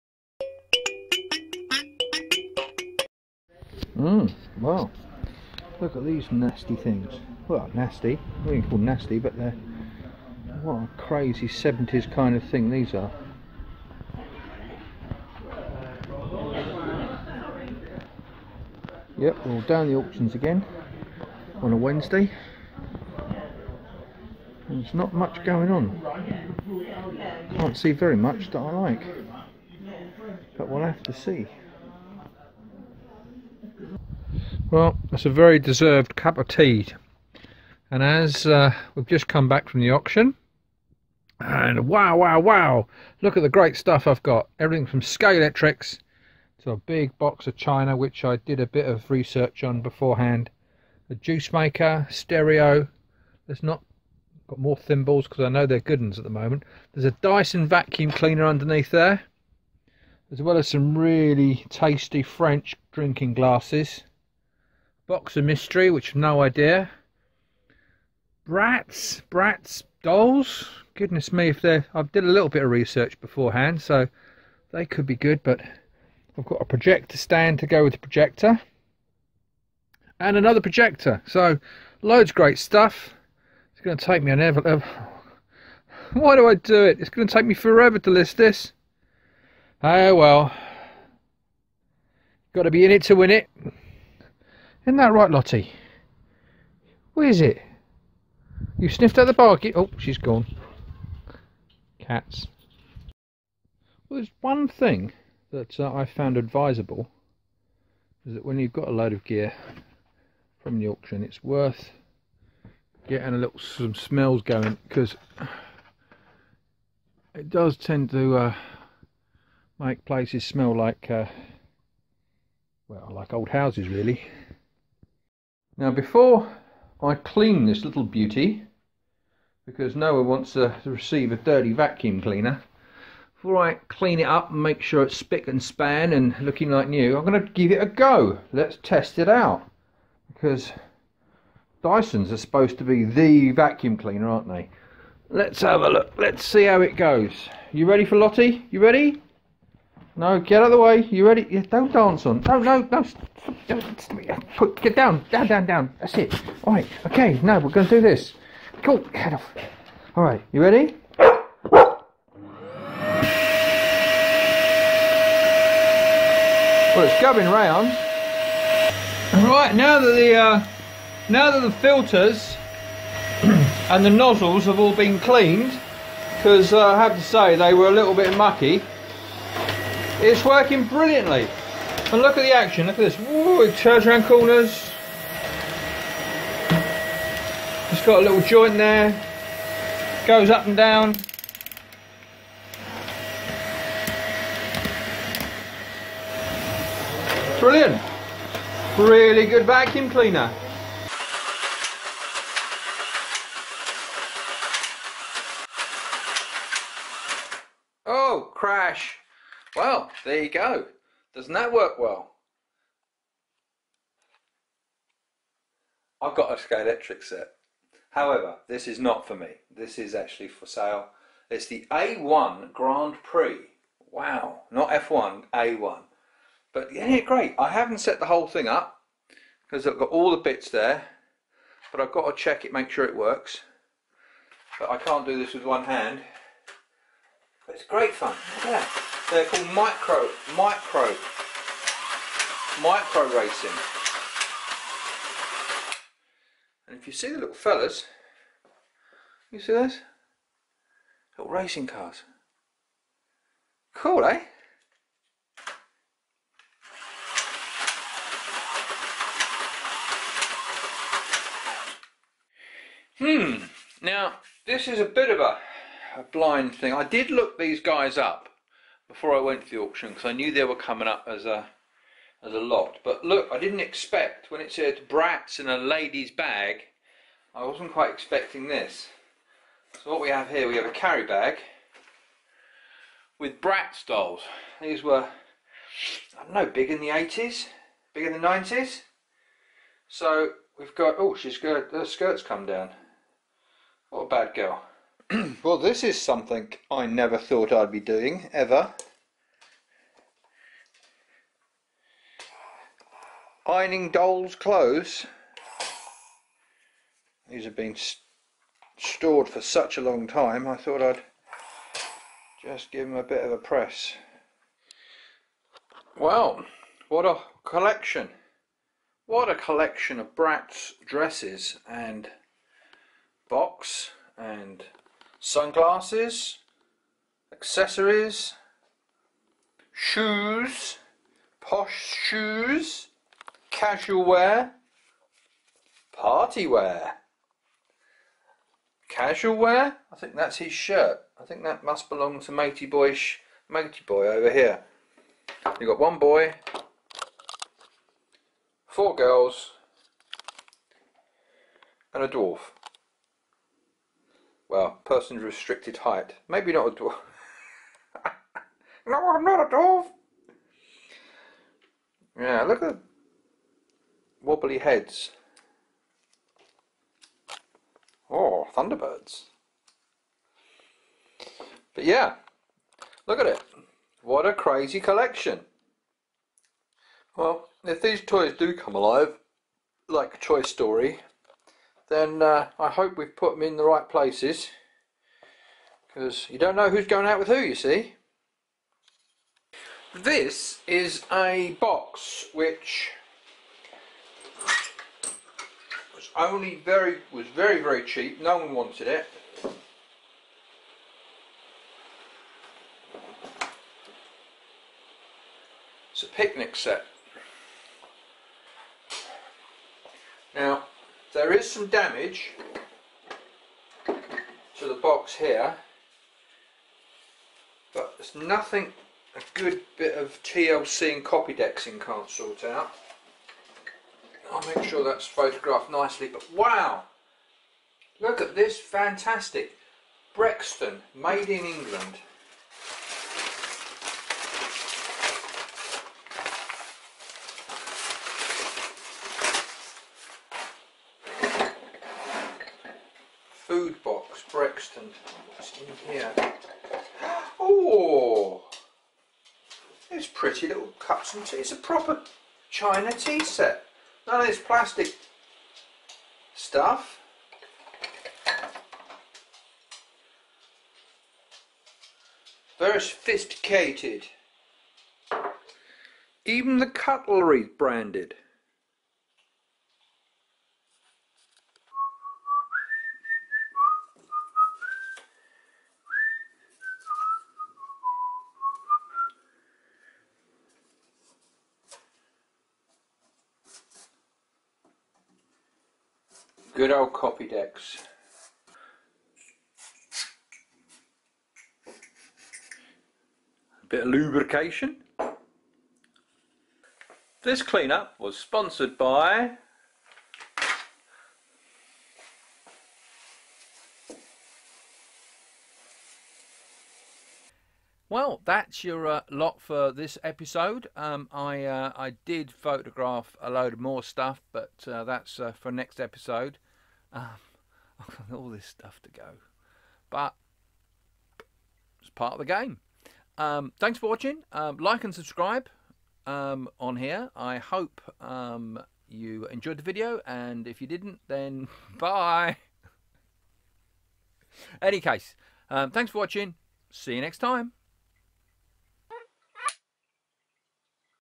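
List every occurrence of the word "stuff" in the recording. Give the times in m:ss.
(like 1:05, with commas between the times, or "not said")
0:43, 1:22, 7:36, 8:34, 8:38.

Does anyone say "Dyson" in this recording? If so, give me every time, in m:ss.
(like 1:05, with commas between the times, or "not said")
0:57, 2:21.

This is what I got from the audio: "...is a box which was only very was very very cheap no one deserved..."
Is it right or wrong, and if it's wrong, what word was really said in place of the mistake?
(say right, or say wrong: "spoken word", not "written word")
wrong: "wanted", not "deserved".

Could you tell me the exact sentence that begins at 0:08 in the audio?
We can call nasty, but they're...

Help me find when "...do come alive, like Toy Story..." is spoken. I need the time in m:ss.
6:18.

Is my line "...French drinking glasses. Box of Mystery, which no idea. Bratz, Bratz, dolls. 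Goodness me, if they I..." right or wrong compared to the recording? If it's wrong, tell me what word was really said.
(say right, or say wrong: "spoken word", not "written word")
right.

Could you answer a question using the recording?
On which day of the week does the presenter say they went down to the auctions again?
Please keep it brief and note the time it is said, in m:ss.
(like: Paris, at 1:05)
Wednesday, at 0:21.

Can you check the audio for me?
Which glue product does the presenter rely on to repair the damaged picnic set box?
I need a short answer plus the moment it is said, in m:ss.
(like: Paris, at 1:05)
Copydex, at 8:07.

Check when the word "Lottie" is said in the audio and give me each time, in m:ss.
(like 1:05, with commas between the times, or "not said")
1:35, 2:28.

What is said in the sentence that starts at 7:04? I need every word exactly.
I'll make sure that's photographed nicely, but wow!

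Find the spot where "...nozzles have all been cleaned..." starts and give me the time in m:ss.
2:54.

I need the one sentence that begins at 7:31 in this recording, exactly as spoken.
It's a proper china tea set.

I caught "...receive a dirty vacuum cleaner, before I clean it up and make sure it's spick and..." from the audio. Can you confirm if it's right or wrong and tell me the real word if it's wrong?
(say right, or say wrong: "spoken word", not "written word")
right.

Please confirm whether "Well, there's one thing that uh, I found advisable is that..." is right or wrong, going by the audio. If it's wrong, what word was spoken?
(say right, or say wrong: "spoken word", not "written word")
right.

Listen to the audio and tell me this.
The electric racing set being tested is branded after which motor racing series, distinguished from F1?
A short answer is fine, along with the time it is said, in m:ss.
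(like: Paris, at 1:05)
A1 Grand Prix, at 3:41.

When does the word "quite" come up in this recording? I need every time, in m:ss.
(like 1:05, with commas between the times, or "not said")
4:37.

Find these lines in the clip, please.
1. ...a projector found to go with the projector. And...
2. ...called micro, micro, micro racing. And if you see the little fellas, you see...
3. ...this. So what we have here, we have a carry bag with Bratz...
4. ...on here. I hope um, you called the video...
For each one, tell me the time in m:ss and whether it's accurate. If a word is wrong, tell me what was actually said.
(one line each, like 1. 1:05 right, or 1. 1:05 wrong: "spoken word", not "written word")
1. 1:16 wrong: "stand", not "found"
2. 3:59 right
3. 4:38 right
4. 8:46 wrong: "enjoyed", not "called".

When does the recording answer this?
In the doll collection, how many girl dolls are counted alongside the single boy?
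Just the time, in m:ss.
5:48.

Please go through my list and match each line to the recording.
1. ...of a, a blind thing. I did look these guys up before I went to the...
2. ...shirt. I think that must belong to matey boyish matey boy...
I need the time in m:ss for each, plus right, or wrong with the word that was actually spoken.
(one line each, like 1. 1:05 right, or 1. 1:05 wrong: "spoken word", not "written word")
1. 4:25 right
2. 5:40 right.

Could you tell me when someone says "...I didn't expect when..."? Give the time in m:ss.
4:33.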